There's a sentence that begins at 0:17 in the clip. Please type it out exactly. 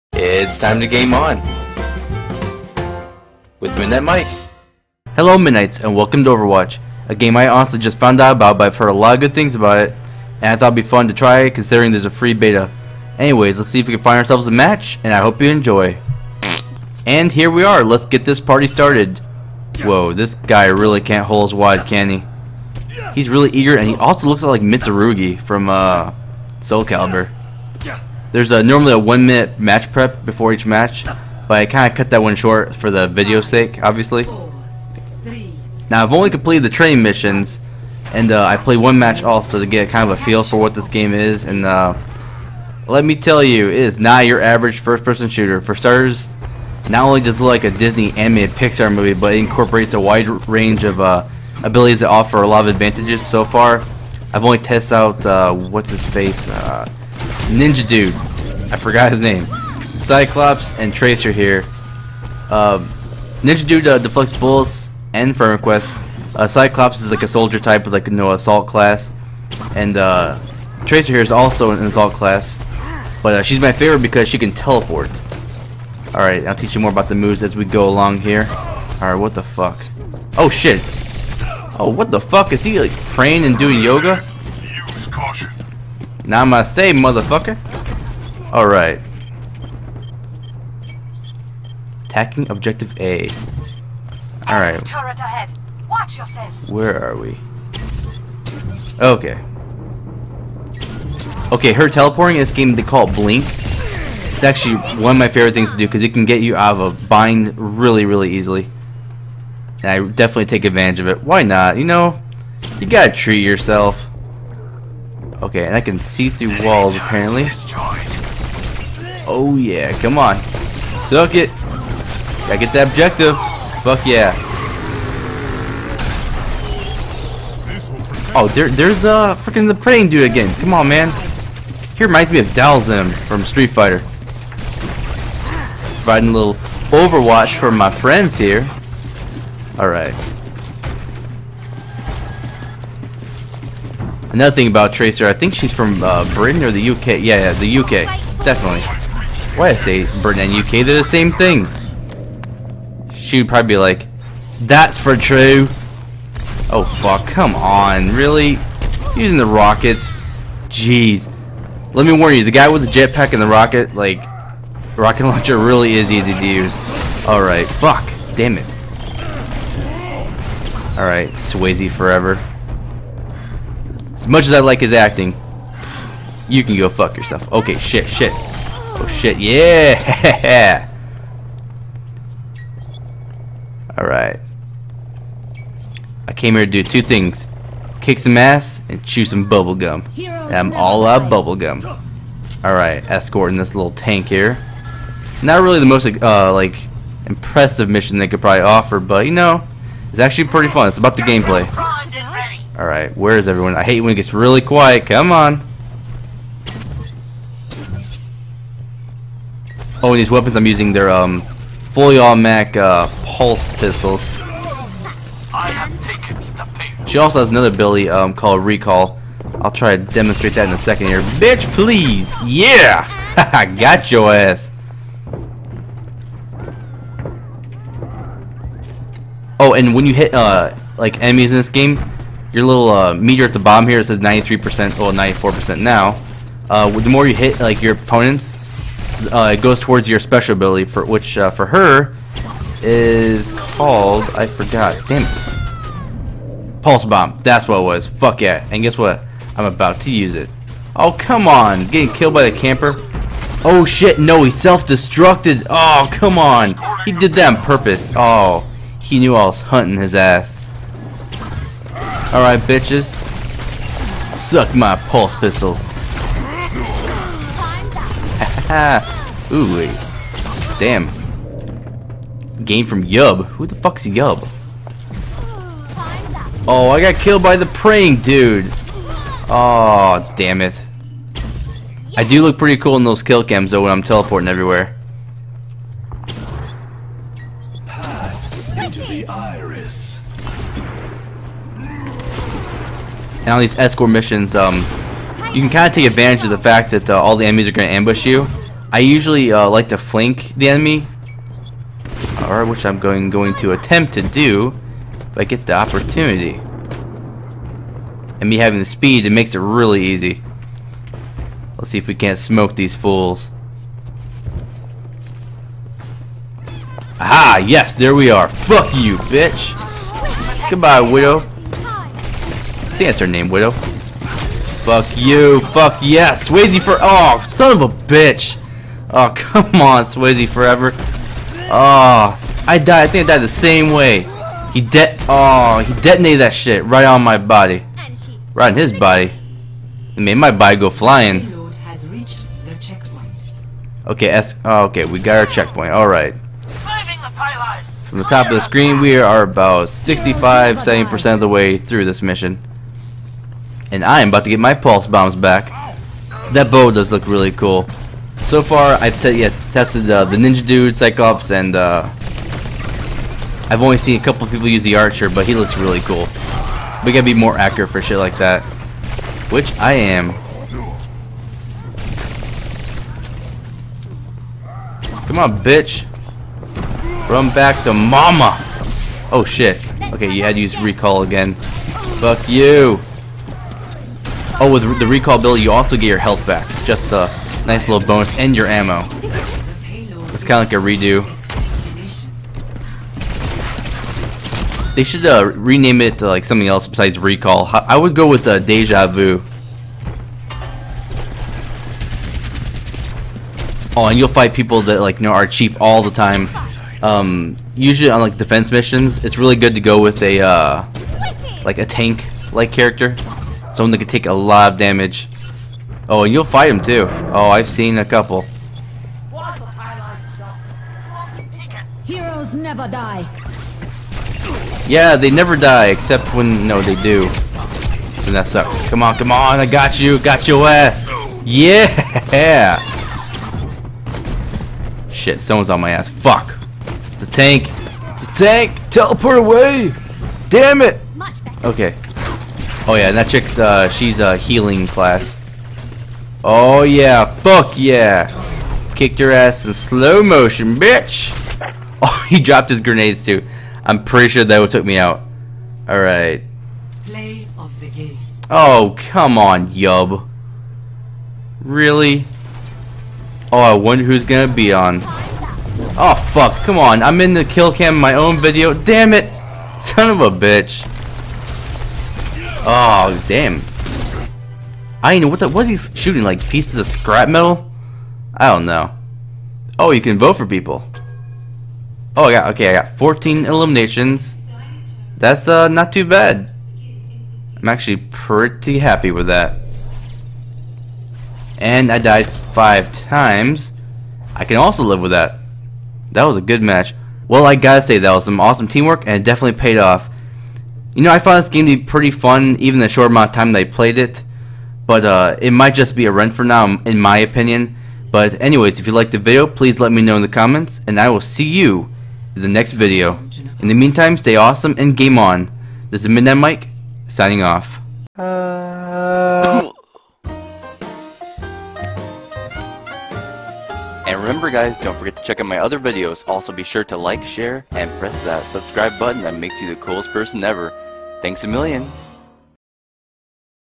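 And here we are, let's get this party started.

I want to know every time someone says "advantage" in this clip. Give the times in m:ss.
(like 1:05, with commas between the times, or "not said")
0:52, 1:50, 4:56.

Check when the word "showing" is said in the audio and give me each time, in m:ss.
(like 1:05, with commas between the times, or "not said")
not said.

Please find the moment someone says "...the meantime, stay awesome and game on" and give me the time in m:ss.
8:33.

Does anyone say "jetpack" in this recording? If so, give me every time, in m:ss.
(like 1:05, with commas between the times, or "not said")
2:42.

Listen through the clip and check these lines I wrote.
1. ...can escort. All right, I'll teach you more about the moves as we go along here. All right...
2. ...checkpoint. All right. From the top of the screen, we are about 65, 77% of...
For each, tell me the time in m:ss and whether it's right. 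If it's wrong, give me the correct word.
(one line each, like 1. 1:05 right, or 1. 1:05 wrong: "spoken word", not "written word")
1. 1:14 wrong: "teleport", not "escort"
2. 5:45 wrong: "70", not "77".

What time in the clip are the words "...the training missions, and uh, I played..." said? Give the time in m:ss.
0:36.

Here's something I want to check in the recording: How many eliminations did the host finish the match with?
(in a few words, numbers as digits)
14.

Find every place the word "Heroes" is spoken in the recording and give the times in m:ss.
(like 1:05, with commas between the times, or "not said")
7:02.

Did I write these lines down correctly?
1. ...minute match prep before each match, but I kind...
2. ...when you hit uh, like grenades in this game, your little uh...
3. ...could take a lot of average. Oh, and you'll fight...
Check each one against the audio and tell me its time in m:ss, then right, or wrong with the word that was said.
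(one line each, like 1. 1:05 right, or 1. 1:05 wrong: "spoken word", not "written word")
1. 0:29 right
2. 3:49 wrong: "enemies", not "grenades"
3. 6:53 wrong: "damage", not "average".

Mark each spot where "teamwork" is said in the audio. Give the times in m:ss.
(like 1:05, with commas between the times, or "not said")
8:18.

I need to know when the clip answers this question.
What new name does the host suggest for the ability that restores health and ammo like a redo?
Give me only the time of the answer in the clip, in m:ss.
6:38.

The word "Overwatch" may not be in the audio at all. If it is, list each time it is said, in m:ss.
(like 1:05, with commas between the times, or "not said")
0:06, 2:16.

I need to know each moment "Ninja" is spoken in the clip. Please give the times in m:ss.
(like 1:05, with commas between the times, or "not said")
0:57, 1:03, 6:00.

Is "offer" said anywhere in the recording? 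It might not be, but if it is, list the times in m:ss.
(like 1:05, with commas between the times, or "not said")
0:52, 3:18.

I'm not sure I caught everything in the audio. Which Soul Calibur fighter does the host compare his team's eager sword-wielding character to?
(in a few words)
Mitsurugi.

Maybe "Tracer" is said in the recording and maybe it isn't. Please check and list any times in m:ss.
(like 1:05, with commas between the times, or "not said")
1:00, 1:10, 2:24.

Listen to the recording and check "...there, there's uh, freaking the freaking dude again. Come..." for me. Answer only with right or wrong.
wrong.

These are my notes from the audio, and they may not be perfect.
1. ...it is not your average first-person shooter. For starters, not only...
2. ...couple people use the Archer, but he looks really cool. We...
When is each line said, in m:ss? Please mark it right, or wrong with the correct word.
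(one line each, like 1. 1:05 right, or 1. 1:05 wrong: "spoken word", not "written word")
1. 0:43 right
2. 6:04 right.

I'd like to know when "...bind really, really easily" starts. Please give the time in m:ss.
1:47.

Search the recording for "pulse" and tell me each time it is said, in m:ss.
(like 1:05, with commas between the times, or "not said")
3:33, 4:06, 4:25, 5:54.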